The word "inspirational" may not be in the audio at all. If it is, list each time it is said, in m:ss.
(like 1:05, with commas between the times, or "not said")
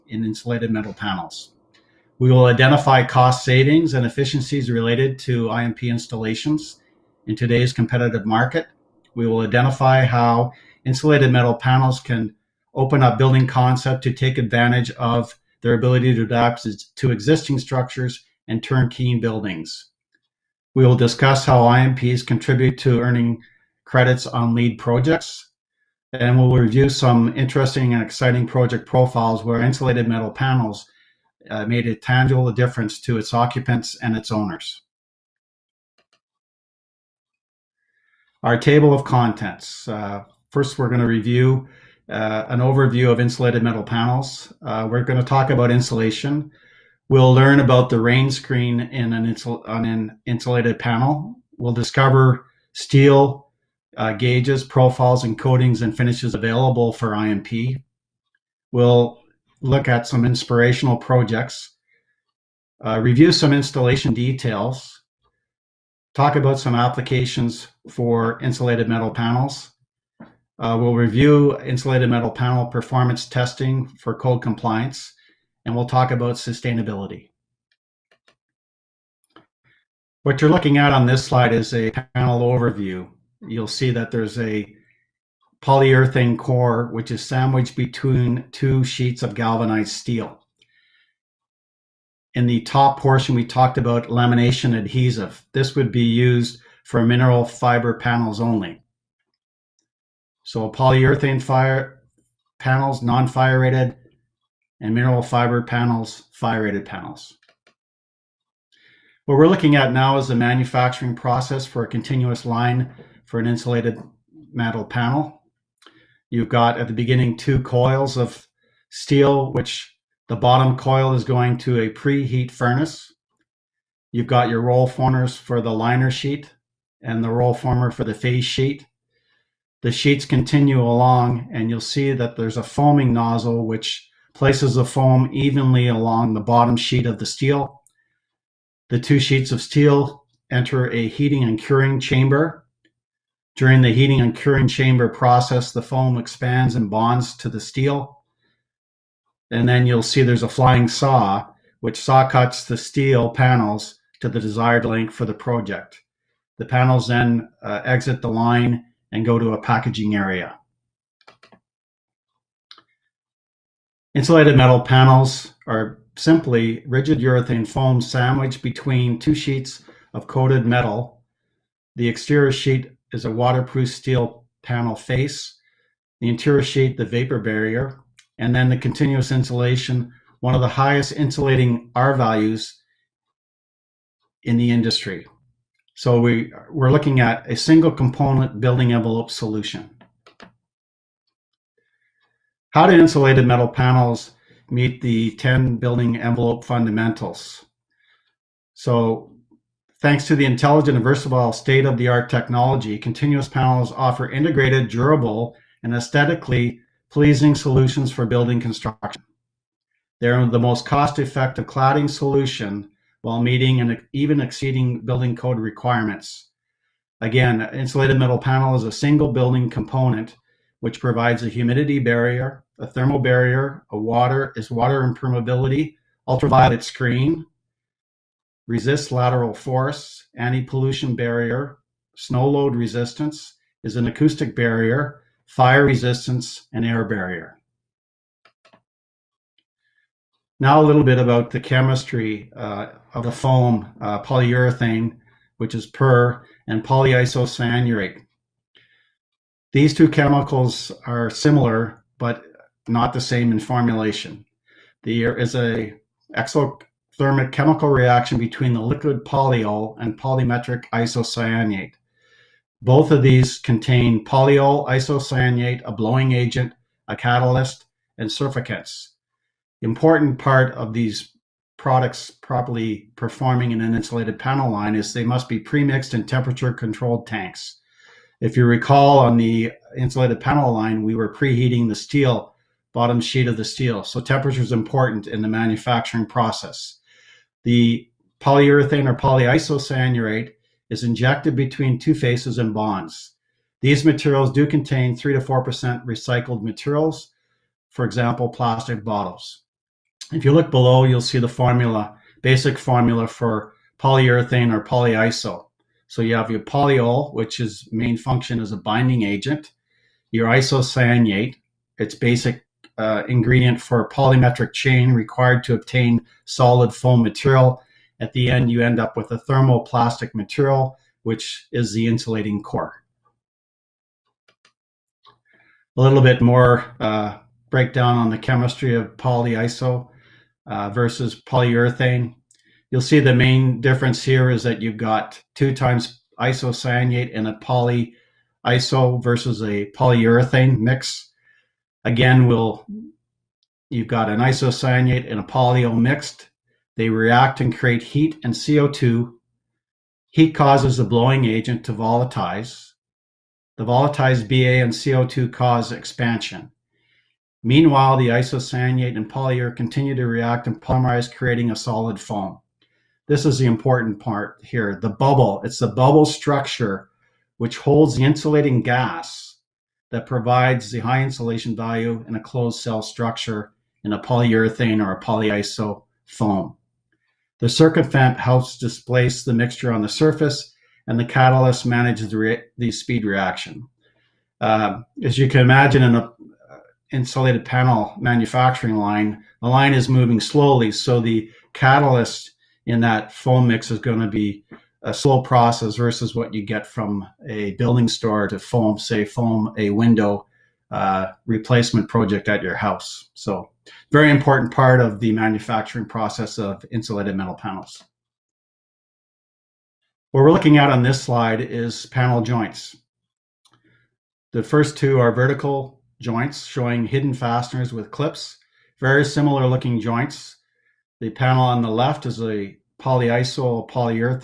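1:00.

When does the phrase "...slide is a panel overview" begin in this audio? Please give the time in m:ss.
1:21.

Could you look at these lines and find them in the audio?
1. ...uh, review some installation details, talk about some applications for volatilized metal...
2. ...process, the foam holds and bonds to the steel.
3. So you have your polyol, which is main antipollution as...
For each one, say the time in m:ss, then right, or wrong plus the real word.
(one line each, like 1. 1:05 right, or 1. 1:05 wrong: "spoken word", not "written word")
1. 1:02 wrong: "insulated", not "volatilized"
2. 2:25 wrong: "expands", not "holds"
3. 5:06 wrong: "function", not "antipollution".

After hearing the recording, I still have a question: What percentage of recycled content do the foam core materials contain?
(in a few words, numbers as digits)
3 to 4%.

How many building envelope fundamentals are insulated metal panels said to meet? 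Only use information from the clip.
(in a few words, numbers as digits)
10.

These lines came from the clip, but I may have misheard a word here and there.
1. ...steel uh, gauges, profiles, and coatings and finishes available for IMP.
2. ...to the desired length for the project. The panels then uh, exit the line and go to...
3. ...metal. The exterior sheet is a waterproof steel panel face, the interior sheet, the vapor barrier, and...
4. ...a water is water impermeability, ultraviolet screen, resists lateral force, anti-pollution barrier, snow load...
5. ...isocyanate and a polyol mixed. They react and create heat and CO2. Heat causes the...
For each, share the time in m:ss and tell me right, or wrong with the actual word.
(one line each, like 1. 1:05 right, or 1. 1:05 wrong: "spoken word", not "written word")
1. 0:52 right
2. 2:34 right
3. 2:50 right
4. 3:43 right
5. 5:44 right.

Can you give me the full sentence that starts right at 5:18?
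At the end, you end up with a thermoplastic material, which is the insulating core.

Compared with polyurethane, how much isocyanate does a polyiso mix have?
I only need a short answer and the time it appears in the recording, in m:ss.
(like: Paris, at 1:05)
two times, at 5:35.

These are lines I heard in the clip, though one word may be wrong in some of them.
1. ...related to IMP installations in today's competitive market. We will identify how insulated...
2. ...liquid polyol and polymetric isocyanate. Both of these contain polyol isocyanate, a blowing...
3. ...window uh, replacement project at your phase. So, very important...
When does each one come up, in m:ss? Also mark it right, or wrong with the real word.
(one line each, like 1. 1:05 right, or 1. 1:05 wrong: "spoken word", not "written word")
1. 0:04 right
2. 4:18 right
3. 6:39 wrong: "house", not "phase".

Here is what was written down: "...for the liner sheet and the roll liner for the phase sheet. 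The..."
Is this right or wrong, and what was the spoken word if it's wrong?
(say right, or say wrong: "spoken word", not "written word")
wrong: "former", not "liner".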